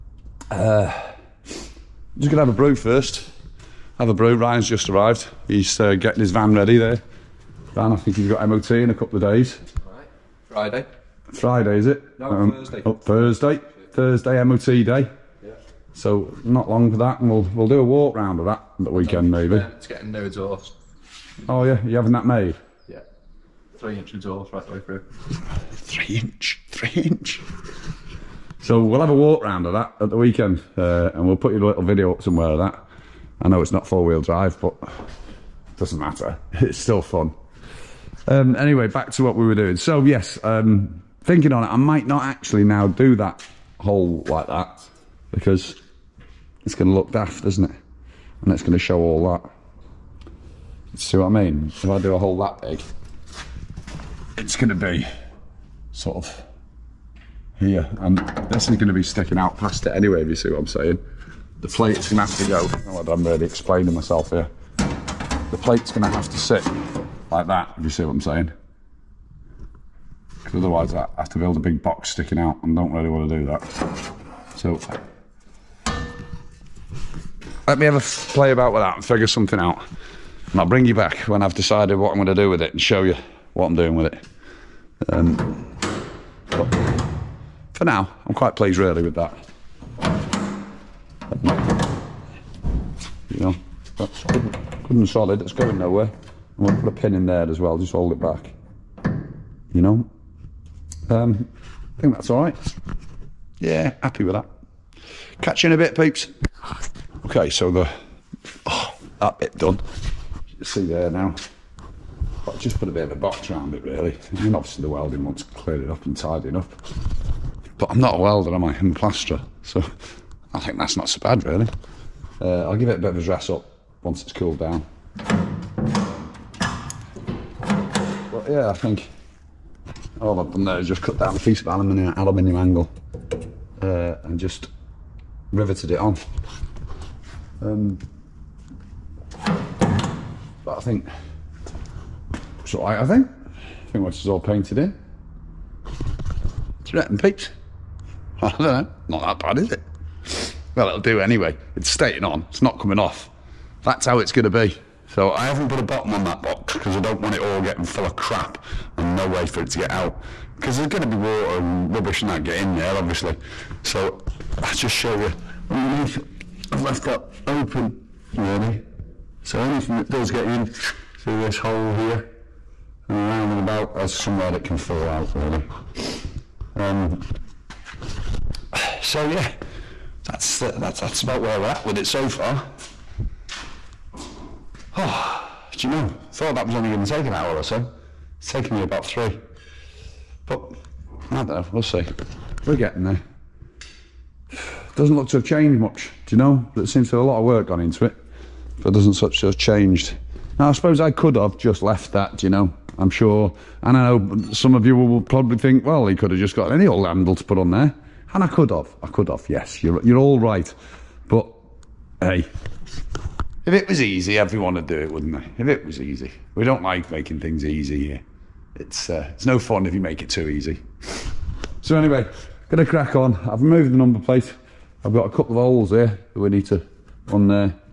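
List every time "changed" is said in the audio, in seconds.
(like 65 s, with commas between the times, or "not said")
195 s, 199 s.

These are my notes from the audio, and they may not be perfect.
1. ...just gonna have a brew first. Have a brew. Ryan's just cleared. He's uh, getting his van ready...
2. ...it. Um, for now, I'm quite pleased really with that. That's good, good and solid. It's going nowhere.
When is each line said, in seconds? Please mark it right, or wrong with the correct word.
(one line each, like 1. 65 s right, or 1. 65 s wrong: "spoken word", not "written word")
1. 1 s wrong: "arrived", not "cleared"
2. 84 s right.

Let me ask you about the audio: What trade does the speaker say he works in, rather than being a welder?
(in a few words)
plasterer.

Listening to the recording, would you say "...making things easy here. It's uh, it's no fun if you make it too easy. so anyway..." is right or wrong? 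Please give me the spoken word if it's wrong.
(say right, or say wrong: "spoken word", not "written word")
right.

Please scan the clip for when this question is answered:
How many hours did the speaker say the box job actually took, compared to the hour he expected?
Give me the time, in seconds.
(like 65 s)
188 s.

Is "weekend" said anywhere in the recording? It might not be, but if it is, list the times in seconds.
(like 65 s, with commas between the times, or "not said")
18 s, 30 s.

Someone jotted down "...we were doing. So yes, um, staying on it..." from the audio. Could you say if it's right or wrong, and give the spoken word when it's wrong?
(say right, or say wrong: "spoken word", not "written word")
wrong: "thinking", not "staying".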